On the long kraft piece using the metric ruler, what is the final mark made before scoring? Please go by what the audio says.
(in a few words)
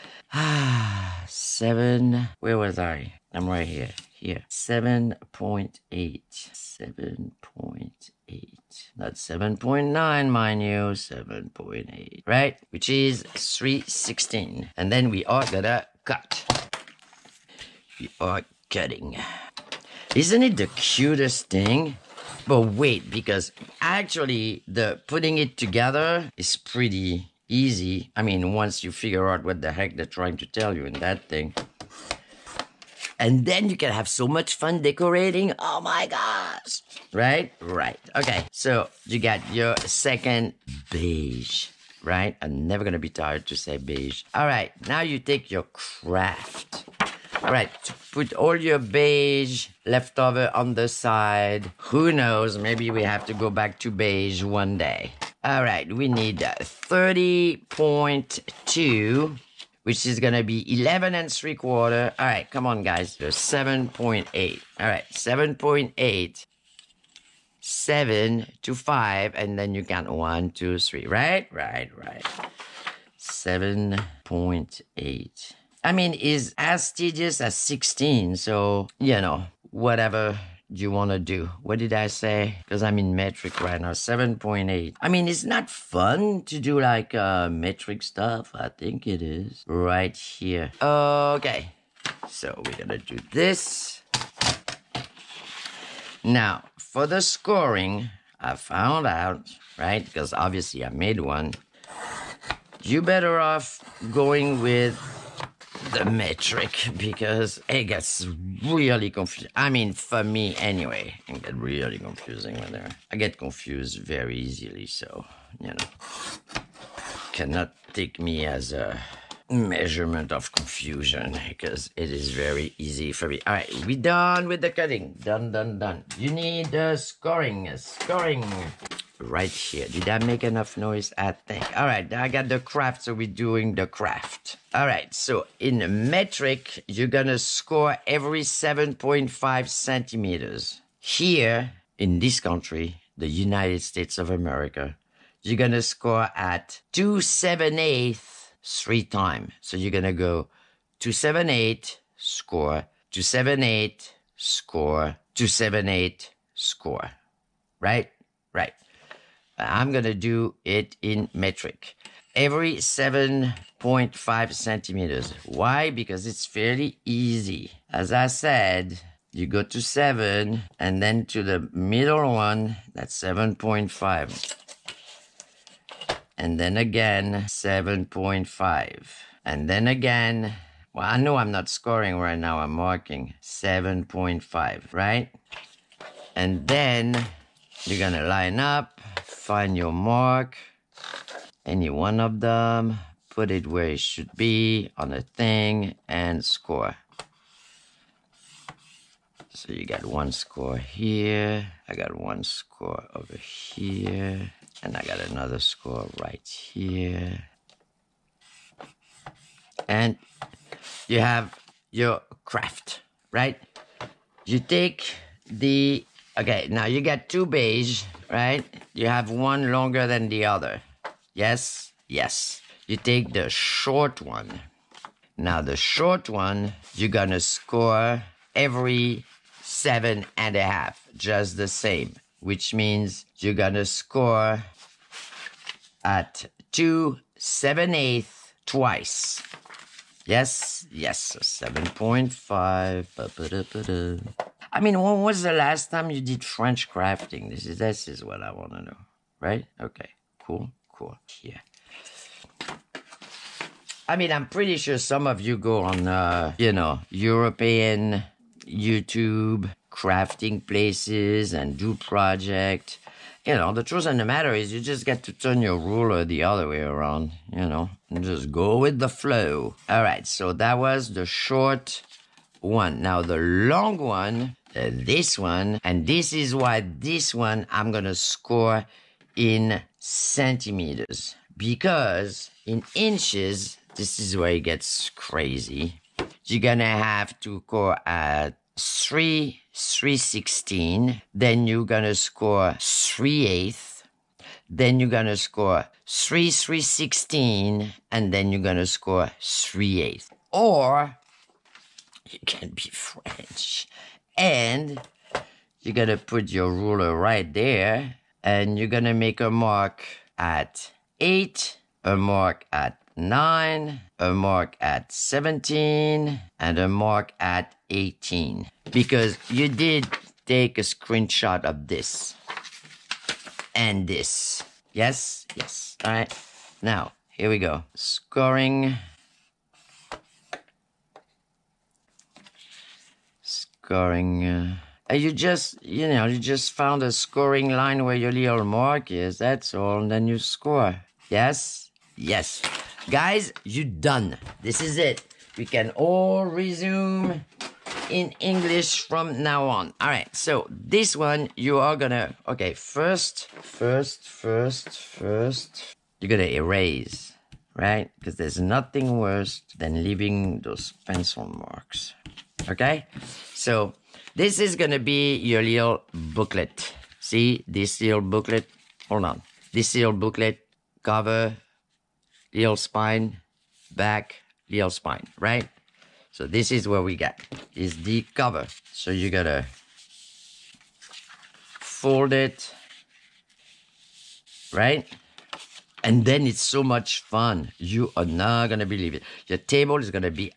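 18.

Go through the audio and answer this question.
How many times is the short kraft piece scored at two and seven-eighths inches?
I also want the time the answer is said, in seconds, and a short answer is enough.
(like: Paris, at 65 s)
twice, at 238 s.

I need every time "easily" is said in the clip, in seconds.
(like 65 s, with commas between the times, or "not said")
114 s.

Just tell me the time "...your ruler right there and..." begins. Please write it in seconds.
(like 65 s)
306 s.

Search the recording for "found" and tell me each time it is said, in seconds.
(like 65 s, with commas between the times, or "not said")
98 s, 336 s.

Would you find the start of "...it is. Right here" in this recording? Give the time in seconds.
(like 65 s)
89 s.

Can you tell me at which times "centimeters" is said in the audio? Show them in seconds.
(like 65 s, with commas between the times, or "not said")
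139 s, 164 s, 279 s.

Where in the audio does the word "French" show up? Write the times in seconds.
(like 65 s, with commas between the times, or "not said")
246 s, 302 s.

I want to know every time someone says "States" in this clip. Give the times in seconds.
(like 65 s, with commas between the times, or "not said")
143 s.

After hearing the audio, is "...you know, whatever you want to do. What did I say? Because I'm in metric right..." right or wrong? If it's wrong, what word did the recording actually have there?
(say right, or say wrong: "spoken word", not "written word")
right.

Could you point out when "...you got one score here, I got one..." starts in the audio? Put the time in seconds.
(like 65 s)
199 s.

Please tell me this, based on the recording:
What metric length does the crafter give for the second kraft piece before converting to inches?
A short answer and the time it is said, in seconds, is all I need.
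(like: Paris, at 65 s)
30.2, at 56 s.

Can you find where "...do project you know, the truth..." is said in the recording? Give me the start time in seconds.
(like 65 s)
261 s.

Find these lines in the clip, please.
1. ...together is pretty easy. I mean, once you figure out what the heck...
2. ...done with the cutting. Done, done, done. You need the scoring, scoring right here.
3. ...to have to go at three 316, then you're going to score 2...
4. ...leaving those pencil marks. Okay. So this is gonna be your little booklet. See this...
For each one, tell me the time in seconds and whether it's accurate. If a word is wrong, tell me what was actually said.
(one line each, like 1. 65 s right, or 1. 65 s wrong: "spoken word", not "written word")
1. 25 s right
2. 123 s right
3. 286 s wrong: "3", not "2"
4. 360 s right.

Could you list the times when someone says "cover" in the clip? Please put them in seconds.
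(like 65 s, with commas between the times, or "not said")
371 s, 378 s.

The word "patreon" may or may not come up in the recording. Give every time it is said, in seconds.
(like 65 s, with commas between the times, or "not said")
not said.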